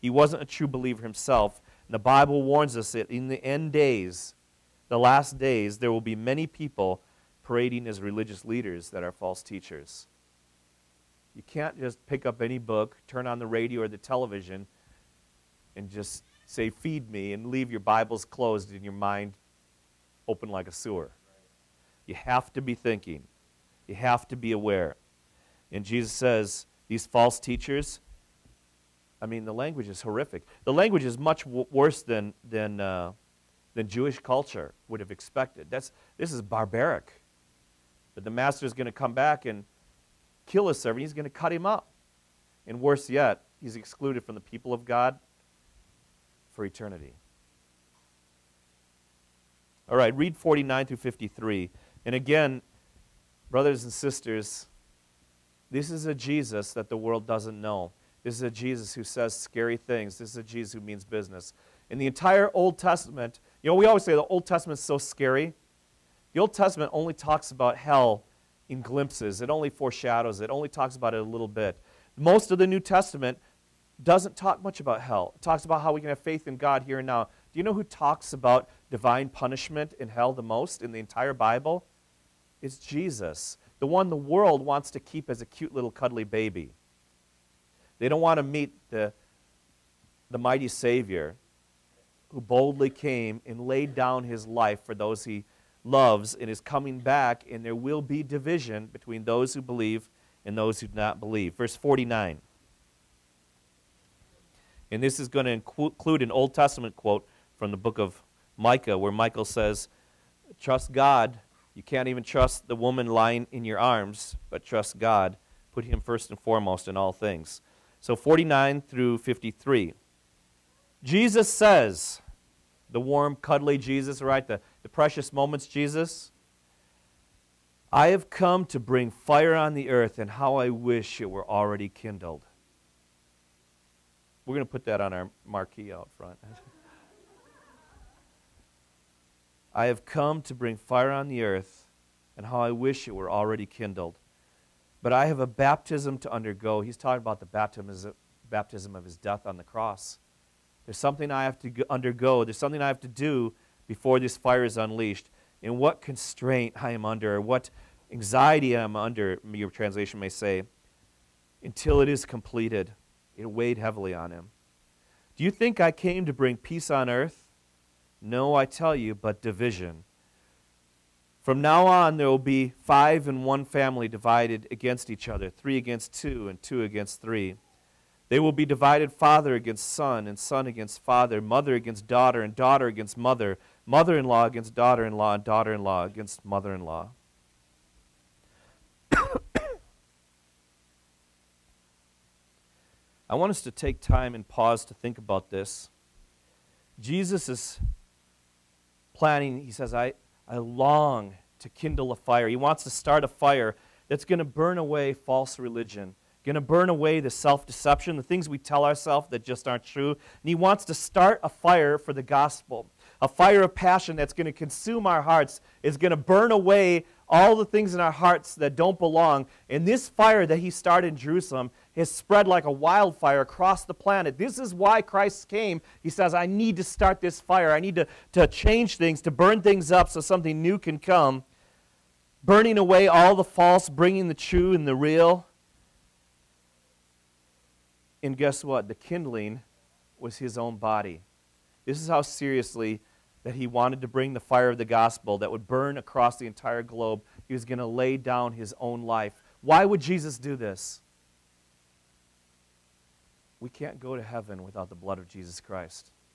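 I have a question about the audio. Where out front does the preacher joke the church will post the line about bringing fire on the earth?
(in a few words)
Our marquee.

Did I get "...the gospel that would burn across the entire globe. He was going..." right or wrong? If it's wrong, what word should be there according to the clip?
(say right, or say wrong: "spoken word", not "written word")
right.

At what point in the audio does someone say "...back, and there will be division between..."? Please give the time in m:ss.
1:36.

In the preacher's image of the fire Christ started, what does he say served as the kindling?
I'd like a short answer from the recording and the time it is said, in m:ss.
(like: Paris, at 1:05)
His own body, at 4:00.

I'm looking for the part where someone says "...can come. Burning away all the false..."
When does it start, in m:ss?
3:50.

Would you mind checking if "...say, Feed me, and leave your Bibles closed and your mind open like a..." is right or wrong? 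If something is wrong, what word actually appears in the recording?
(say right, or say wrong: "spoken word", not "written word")
right.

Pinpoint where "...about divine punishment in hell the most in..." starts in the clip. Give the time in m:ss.
1:18.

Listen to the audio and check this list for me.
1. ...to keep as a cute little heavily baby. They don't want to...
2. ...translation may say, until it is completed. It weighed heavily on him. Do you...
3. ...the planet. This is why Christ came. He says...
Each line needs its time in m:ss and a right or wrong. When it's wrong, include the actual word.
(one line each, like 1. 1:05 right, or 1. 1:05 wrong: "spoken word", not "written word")
1. 1:24 wrong: "cuddly", not "heavily"
2. 2:39 right
3. 3:43 right.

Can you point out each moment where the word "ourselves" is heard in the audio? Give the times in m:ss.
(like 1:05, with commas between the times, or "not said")
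3:28.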